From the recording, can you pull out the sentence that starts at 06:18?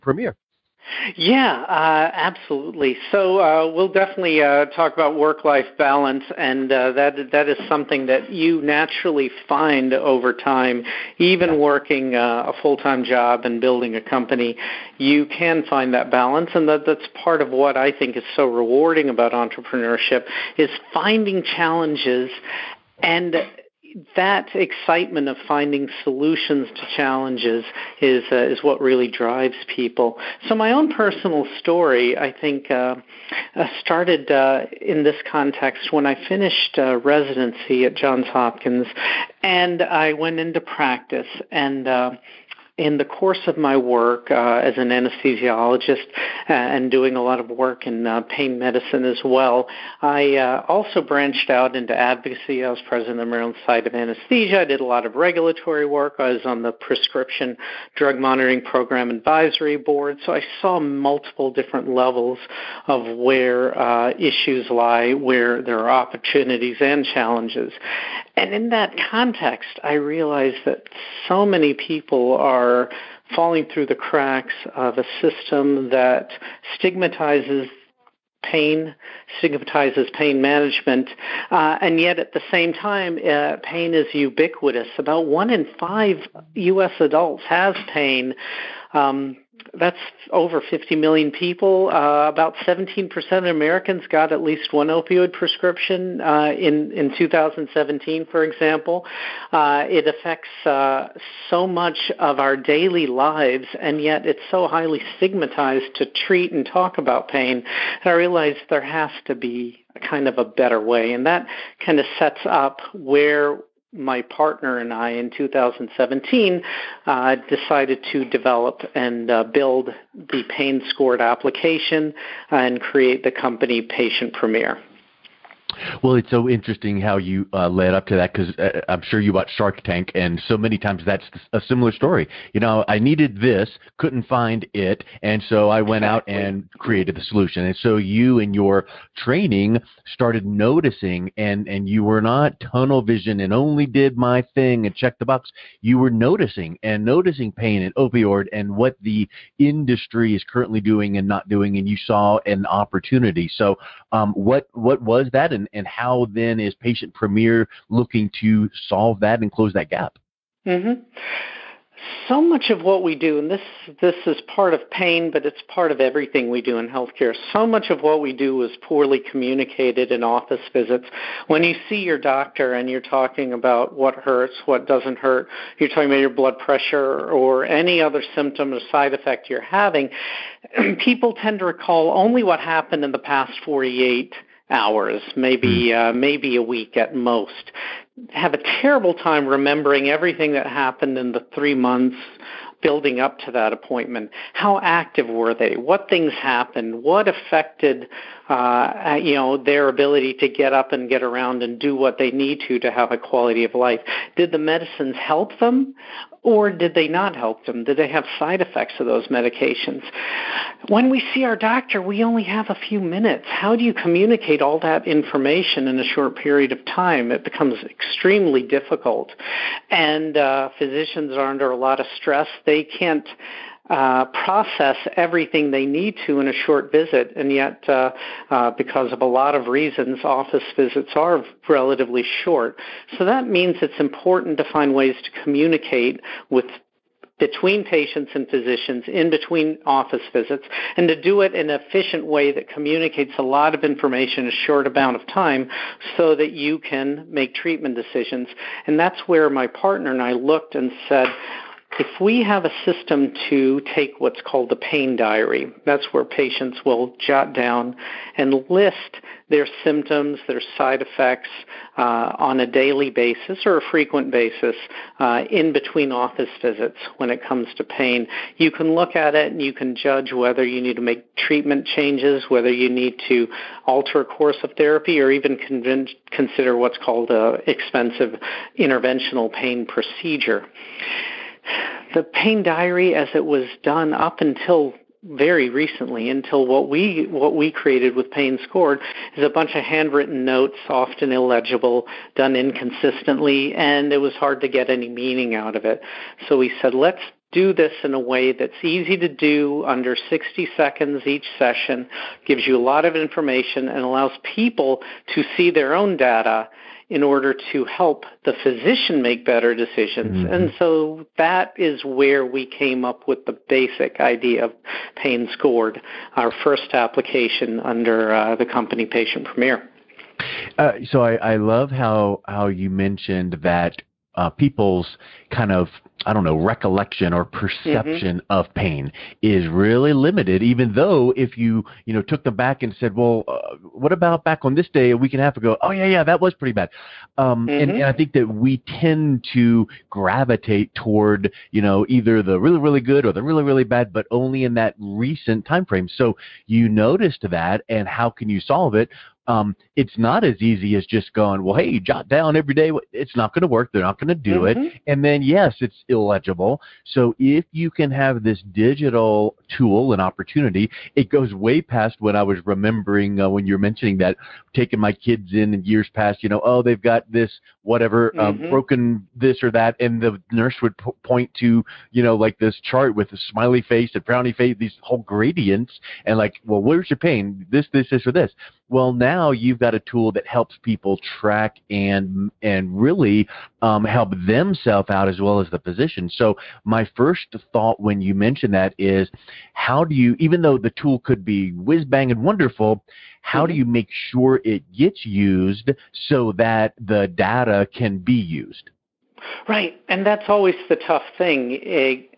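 Well, now you've got a tool that helps people track and and really um, help themselves out as well as the physician.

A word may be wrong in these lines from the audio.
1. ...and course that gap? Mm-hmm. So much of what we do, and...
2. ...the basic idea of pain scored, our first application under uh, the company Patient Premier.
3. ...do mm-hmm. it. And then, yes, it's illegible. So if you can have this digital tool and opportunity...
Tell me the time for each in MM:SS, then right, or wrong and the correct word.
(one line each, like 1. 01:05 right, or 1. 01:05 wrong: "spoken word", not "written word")
1. 02:39 wrong: "close", not "course"
2. 05:13 right
3. 05:54 right.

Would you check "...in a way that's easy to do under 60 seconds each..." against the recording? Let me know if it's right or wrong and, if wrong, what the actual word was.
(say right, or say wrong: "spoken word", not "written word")
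right.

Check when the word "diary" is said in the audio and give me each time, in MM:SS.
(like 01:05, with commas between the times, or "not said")
04:15, 04:42.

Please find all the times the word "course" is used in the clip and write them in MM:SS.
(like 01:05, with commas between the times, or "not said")
00:43, 04:34.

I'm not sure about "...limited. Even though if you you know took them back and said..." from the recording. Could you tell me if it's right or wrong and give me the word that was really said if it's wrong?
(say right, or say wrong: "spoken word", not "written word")
right.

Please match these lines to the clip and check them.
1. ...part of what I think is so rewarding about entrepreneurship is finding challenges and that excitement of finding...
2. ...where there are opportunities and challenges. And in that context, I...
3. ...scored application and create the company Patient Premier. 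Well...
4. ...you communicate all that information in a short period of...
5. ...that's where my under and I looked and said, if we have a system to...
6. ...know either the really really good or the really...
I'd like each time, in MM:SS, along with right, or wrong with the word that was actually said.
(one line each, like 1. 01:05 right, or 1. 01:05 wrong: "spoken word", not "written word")
1. 00:17 right
2. 01:05 right
3. 02:00 right
4. 03:33 right
5. 04:08 wrong: "partner", not "under"
6. 05:41 right.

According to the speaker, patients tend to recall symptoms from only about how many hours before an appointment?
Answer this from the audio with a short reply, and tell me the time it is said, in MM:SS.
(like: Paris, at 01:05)
48 hours, at 03:03.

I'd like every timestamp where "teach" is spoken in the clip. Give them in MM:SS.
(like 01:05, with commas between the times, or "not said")
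not said.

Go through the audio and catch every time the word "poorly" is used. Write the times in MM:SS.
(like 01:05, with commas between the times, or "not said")
02:48.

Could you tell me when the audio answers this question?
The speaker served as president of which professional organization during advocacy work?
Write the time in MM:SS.
00:53.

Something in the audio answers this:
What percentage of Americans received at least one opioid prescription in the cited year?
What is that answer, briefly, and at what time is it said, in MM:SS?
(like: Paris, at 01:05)
17%, at 01:32.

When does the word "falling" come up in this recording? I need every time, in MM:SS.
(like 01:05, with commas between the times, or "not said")
01:13.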